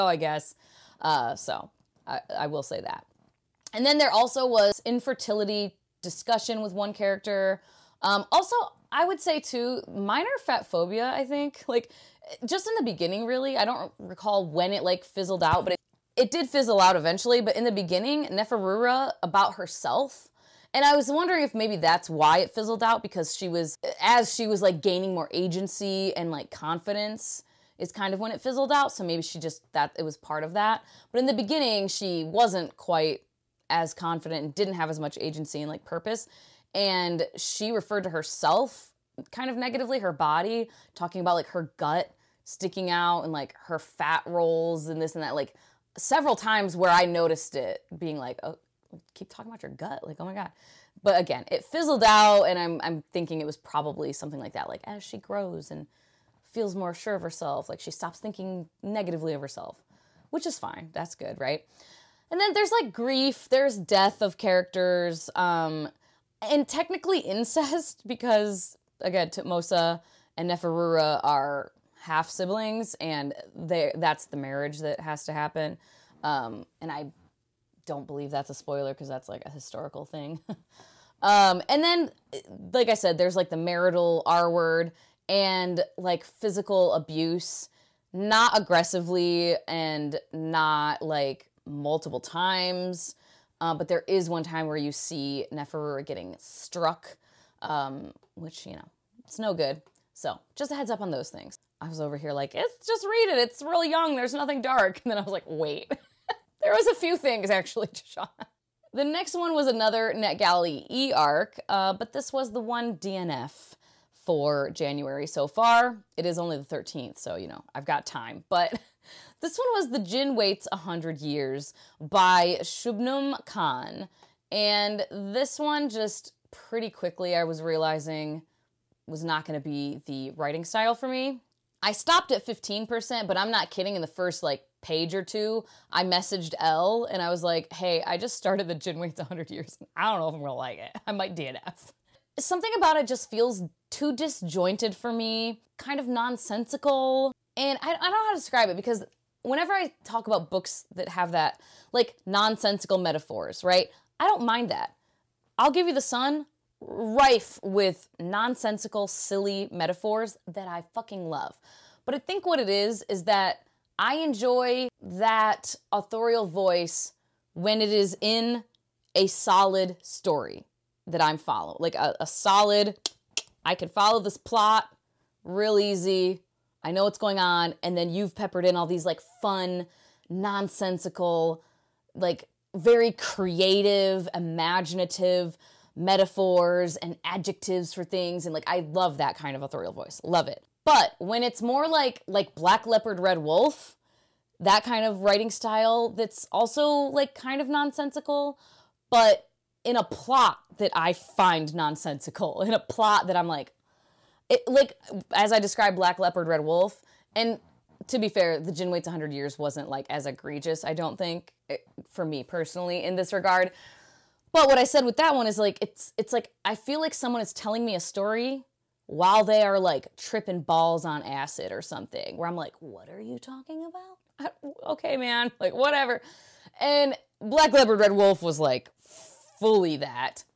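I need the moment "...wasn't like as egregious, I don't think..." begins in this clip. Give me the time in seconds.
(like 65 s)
209 s.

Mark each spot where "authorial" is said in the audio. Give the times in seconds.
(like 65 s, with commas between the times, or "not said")
165 s, 189 s.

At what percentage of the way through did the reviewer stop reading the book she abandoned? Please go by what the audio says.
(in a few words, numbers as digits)
15%.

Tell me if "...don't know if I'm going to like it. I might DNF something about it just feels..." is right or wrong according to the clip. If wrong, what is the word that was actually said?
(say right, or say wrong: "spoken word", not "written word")
right.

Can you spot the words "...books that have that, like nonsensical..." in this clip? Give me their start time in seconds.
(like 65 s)
150 s.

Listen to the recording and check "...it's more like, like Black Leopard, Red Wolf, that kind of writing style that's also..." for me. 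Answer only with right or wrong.
right.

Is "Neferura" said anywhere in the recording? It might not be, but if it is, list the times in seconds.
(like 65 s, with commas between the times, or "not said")
18 s, 70 s, 95 s.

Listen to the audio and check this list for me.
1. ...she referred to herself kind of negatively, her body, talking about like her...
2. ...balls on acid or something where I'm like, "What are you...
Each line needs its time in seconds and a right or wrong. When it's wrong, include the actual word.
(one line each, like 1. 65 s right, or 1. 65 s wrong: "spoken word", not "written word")
1. 37 s right
2. 220 s right.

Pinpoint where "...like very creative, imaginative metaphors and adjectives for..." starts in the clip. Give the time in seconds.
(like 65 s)
182 s.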